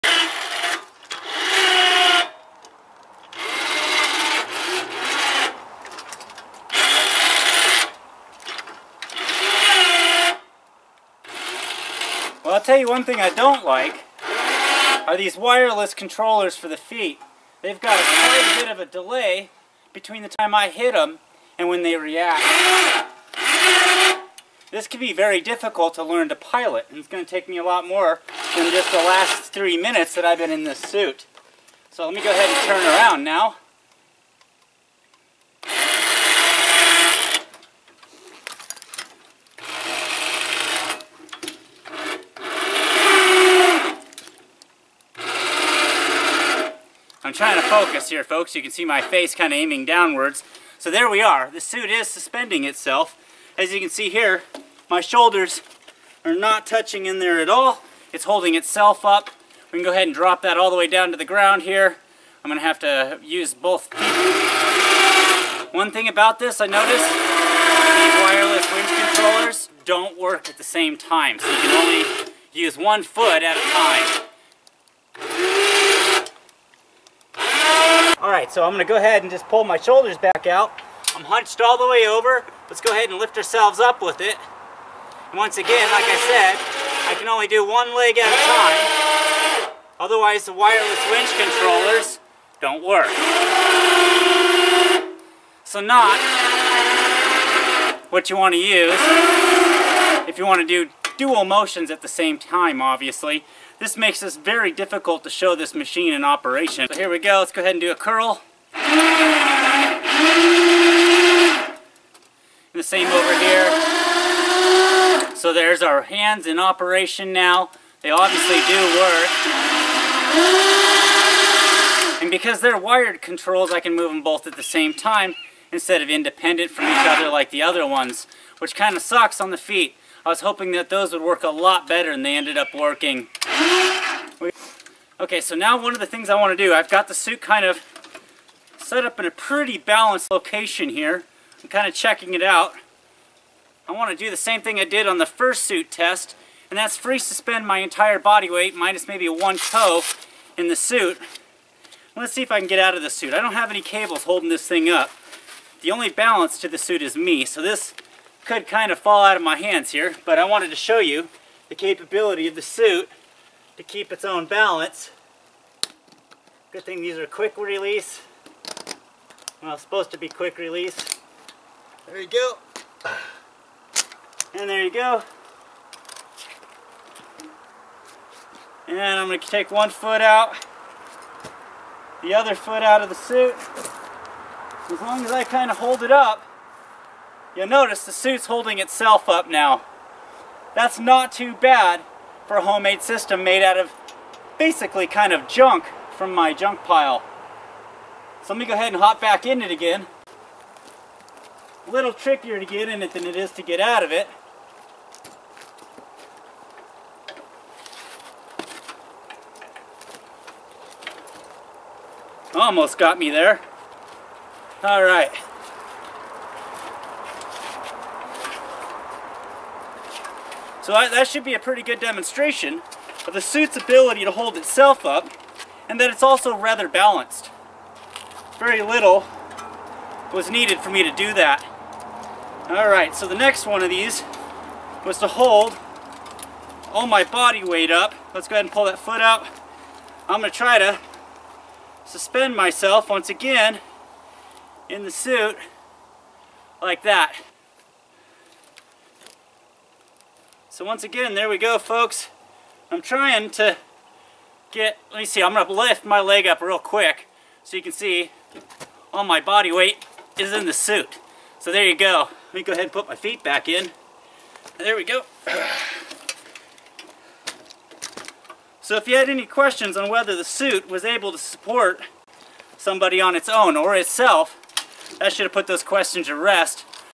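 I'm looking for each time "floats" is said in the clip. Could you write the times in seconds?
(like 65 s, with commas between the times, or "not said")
not said.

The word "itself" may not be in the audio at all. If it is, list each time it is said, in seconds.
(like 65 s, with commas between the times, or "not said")
52 s, 58 s, 188 s, 224 s, 273 s.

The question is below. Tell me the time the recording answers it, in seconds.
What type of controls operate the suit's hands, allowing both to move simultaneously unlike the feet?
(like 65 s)
122 s.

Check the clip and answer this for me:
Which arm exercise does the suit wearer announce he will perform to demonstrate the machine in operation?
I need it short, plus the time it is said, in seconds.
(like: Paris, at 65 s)
a curl, at 107 s.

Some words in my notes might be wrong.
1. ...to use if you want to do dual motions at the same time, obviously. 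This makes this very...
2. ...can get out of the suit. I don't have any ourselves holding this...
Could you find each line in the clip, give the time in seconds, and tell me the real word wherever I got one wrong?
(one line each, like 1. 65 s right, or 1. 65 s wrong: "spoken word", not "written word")
1. 98 s right
2. 152 s wrong: "cables", not "ourselves".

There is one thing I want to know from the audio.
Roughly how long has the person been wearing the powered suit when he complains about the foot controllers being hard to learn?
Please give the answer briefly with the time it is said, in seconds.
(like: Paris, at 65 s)
3 minutes, at 29 s.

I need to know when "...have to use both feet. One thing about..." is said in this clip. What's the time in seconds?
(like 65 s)
62 s.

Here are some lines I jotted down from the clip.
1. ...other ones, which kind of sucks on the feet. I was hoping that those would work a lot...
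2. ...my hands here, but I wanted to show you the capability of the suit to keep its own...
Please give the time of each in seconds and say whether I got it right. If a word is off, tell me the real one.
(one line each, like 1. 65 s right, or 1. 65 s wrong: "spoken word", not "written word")
1. 127 s right
2. 159 s right.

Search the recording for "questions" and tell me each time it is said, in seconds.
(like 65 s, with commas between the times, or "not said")
269 s, 275 s.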